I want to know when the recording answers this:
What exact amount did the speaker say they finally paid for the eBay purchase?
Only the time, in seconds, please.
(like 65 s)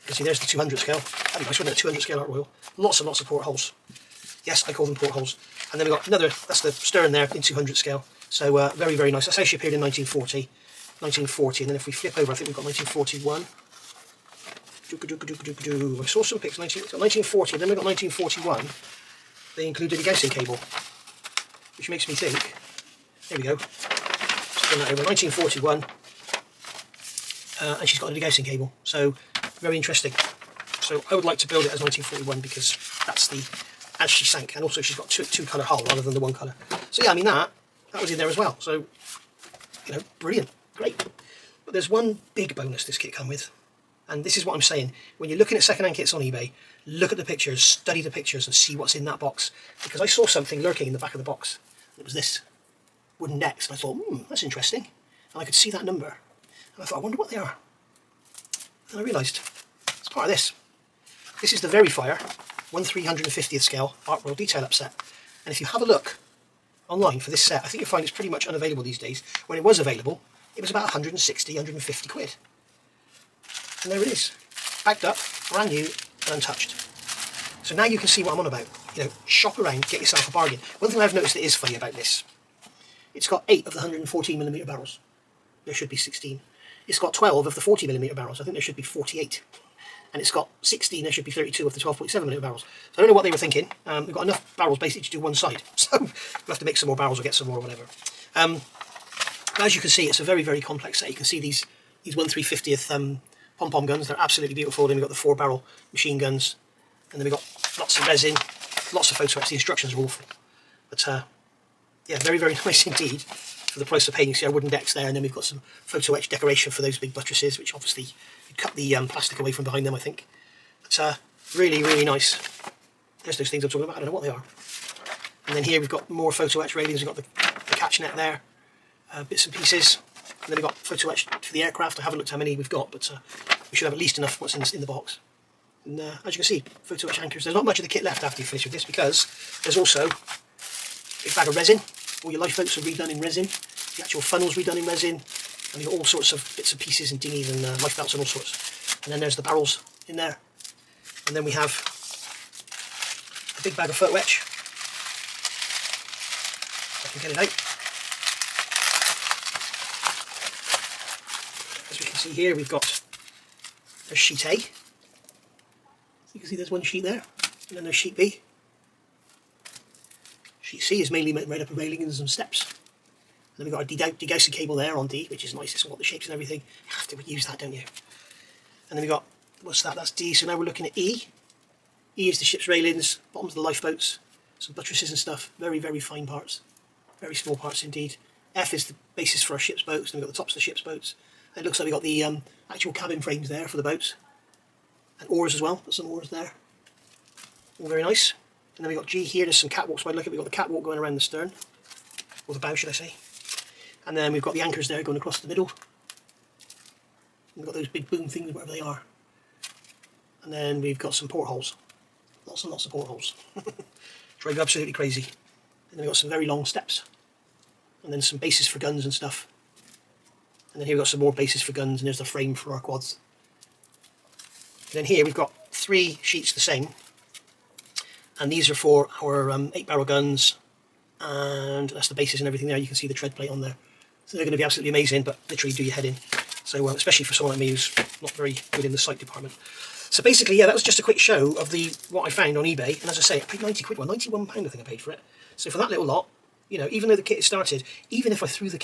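244 s.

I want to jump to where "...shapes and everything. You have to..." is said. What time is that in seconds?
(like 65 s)
176 s.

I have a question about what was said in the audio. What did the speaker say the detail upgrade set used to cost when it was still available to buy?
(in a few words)
about 160 or 150 quid.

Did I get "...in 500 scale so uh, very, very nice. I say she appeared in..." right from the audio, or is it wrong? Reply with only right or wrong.
wrong.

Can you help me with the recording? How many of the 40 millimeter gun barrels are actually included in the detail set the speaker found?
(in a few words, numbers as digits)
12.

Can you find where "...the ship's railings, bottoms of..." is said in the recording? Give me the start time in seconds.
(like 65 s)
182 s.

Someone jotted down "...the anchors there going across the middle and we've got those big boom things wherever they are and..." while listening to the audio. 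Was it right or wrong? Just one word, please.
right.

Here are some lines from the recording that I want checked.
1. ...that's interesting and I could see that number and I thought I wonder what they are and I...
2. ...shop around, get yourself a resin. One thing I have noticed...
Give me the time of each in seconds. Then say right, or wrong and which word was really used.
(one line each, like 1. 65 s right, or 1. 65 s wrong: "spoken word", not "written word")
1. 54 s right
2. 79 s wrong: "bargain", not "resin".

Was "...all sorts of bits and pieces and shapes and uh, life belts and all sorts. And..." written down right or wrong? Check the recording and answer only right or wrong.
wrong.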